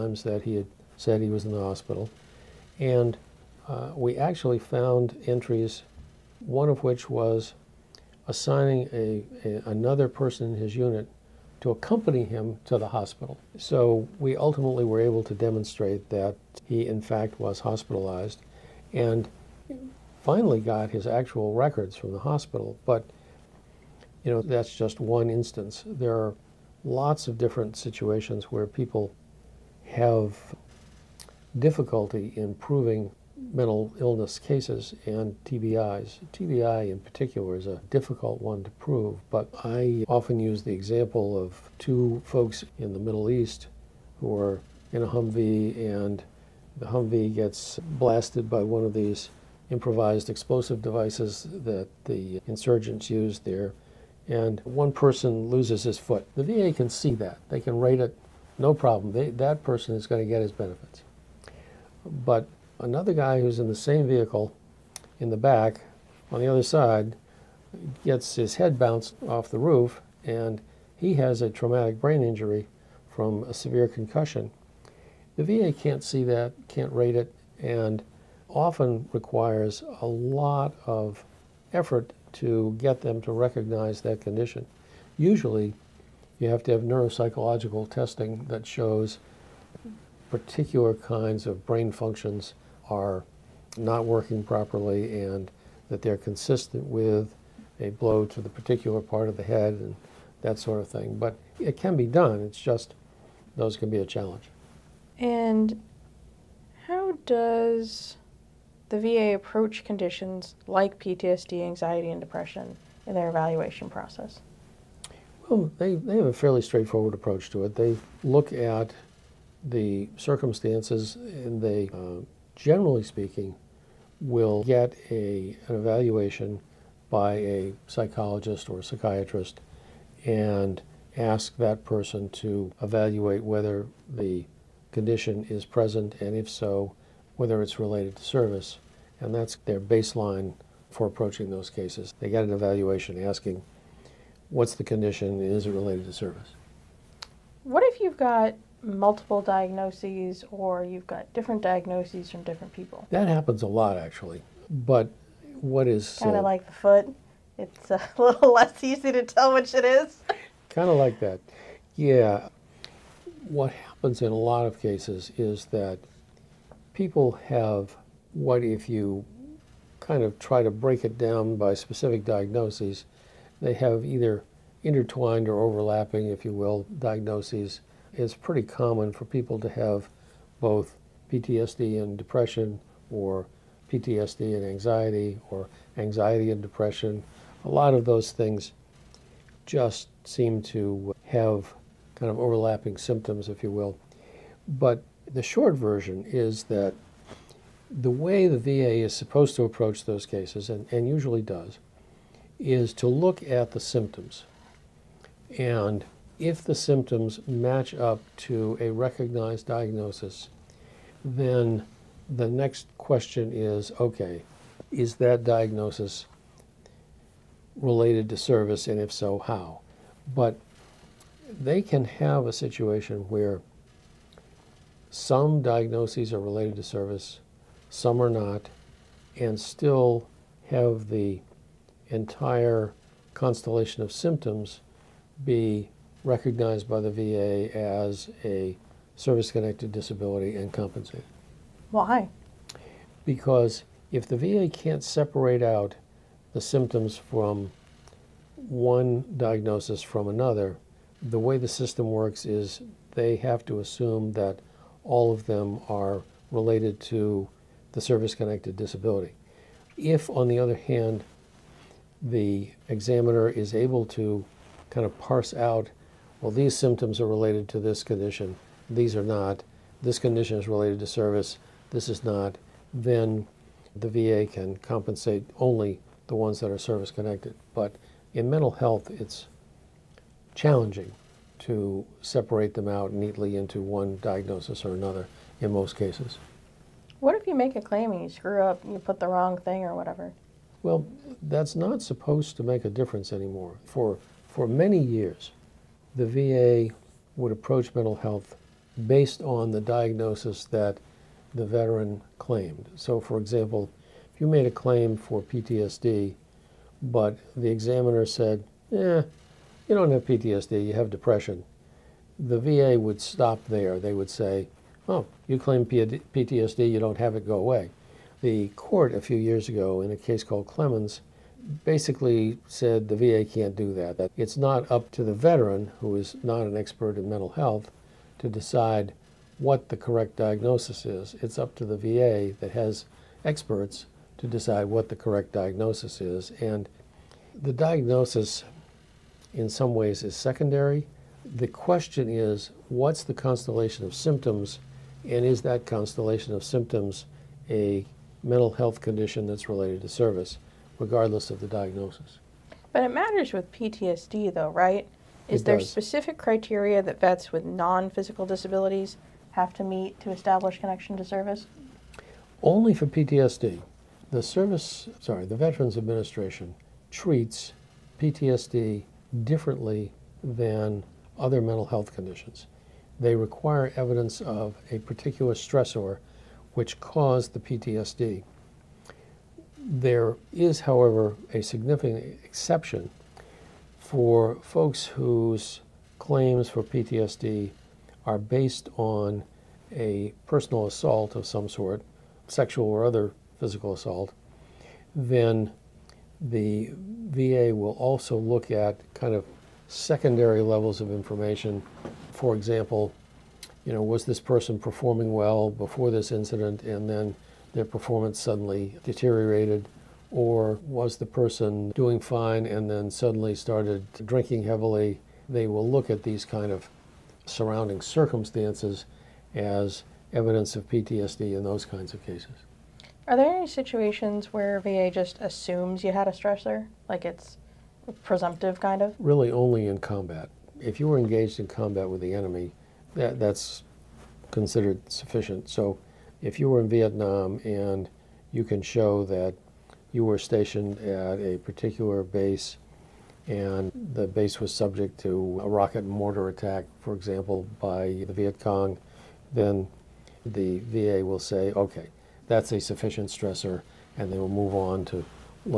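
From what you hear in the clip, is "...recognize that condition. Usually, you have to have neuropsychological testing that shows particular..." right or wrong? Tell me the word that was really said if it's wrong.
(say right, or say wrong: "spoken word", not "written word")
right.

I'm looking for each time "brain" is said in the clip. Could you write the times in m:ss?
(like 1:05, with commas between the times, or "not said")
1:11, 1:31.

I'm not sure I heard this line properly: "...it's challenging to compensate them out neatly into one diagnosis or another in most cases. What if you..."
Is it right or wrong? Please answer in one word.
wrong.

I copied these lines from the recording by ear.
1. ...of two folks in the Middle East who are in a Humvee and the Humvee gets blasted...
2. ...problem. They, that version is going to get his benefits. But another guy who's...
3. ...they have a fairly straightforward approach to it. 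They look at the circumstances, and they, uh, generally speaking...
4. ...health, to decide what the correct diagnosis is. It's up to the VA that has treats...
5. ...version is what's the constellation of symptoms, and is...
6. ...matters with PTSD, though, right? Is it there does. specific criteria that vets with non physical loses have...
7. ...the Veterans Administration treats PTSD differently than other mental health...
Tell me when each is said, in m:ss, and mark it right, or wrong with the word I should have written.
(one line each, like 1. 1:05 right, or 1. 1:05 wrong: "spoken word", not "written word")
1. 0:41 right
2. 0:58 wrong: "person", not "version"
3. 1:55 right
4. 5:27 wrong: "experts", not "treats"
5. 5:41 wrong: "question", not "version"
6. 5:53 wrong: "disabilities", not "loses"
7. 6:05 right.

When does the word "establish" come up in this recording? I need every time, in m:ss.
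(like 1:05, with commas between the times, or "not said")
6:00.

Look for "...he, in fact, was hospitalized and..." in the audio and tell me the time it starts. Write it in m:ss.
0:16.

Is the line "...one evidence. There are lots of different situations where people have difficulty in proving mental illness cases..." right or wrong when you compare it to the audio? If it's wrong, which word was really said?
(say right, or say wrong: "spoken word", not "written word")
wrong: "instance", not "evidence".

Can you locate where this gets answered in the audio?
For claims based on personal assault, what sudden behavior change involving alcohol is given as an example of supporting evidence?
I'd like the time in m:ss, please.
6:54.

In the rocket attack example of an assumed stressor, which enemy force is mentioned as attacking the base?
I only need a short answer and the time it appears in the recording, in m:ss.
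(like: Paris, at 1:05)
Viet Cong, at 7:28.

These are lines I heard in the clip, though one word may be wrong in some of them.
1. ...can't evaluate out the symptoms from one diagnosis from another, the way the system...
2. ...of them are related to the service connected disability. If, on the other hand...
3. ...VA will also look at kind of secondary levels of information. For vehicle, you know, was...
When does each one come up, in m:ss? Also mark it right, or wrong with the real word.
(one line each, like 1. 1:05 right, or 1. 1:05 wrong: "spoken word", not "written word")
1. 4:04 wrong: "separate", not "evaluate"
2. 4:15 right
3. 6:37 wrong: "example", not "vehicle".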